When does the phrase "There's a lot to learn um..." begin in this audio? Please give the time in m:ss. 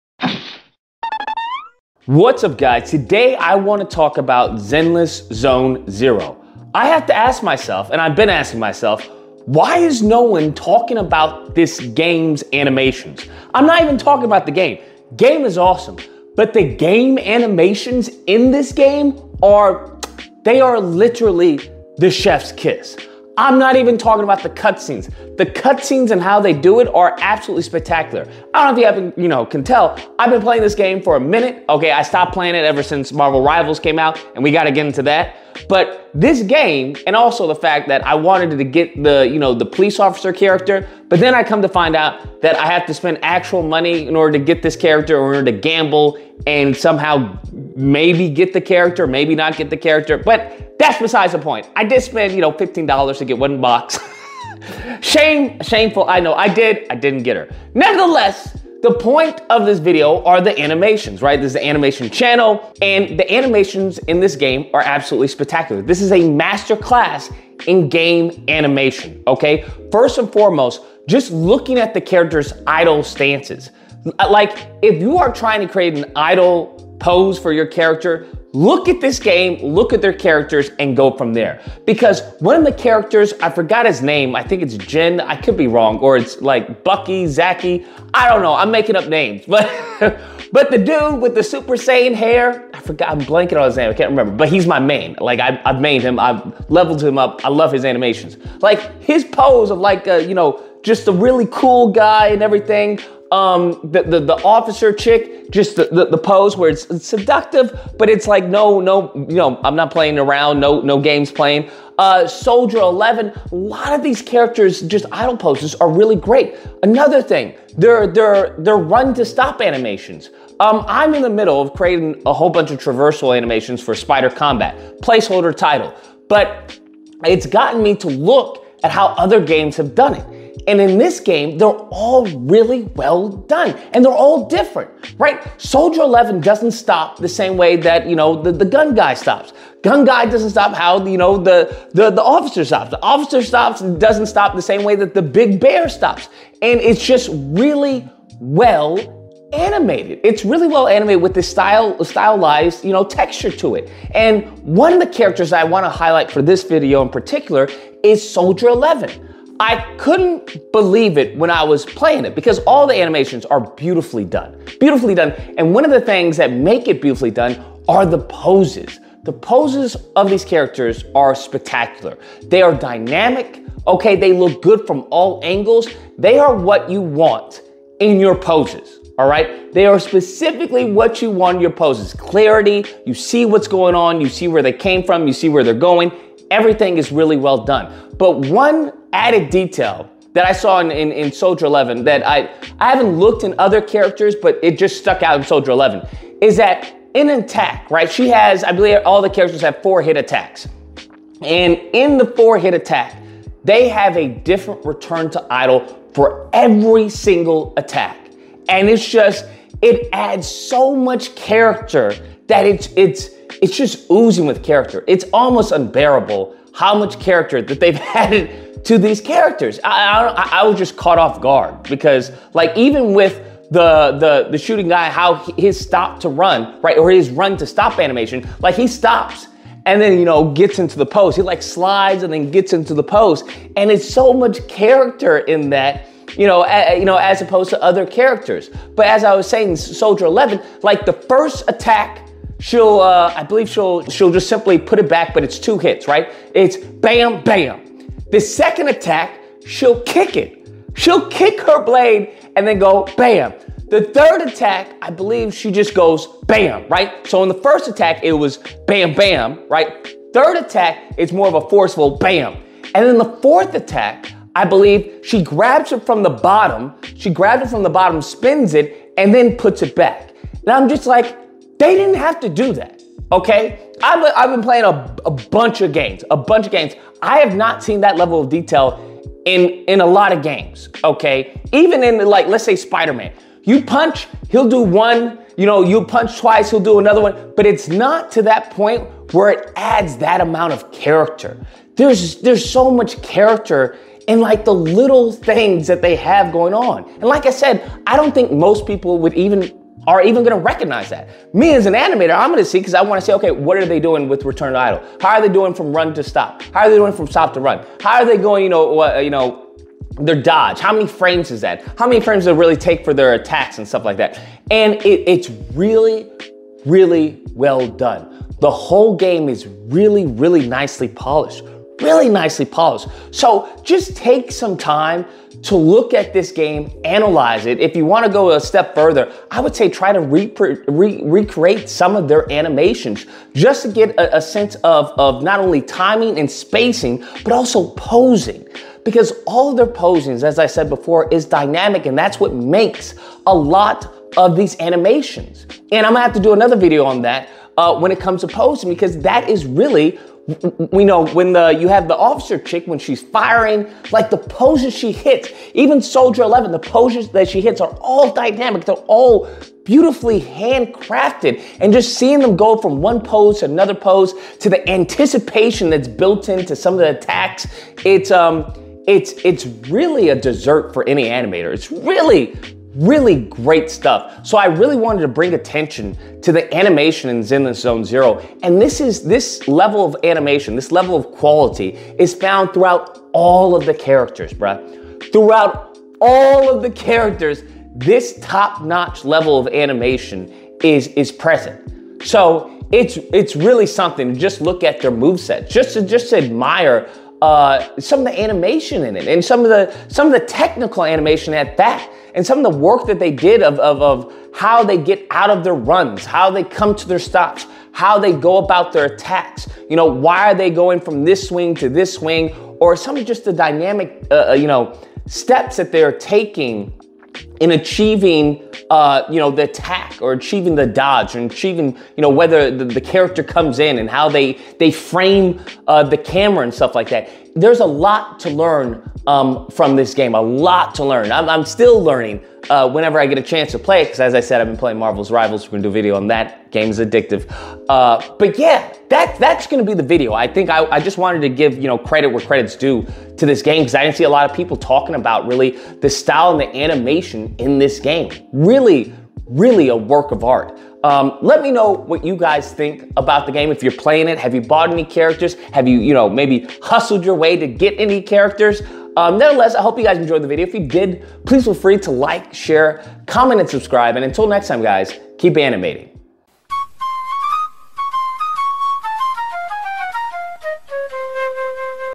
7:07.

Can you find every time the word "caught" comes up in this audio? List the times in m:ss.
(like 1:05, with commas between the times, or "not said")
3:40.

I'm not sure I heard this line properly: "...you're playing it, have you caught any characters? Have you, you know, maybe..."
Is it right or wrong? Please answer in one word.
wrong.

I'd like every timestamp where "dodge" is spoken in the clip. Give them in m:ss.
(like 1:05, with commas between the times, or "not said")
5:10, 7:00.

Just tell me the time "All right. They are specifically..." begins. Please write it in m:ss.
2:59.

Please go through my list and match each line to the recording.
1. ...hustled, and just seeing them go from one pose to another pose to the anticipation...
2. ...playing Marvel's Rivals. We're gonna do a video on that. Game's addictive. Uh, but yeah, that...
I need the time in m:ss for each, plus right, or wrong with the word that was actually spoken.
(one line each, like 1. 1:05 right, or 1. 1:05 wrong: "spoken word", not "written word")
1. 6:00 wrong: "handcrafted", not "hustled"
2. 7:14 right.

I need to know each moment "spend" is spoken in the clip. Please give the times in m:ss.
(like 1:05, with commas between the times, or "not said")
0:42, 0:52.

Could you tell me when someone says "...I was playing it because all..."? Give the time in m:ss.
2:41.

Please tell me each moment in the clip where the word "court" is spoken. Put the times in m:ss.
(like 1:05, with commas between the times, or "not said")
not said.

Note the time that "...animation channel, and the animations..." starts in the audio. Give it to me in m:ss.
1:01.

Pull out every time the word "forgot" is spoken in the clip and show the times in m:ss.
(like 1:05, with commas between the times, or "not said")
1:23, 1:32.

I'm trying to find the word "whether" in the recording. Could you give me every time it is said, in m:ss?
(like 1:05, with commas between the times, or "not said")
7:02.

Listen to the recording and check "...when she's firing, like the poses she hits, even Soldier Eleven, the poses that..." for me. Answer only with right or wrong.
right.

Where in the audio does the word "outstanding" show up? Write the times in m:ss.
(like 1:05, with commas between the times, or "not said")
not said.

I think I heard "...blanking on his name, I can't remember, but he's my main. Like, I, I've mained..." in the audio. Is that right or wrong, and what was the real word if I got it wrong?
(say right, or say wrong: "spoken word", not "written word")
right.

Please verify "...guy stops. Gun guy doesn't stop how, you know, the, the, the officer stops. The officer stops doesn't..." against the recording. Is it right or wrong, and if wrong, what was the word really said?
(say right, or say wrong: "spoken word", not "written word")
right.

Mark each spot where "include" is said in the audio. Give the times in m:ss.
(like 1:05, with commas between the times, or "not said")
not said.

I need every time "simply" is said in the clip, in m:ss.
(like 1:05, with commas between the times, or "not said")
4:04.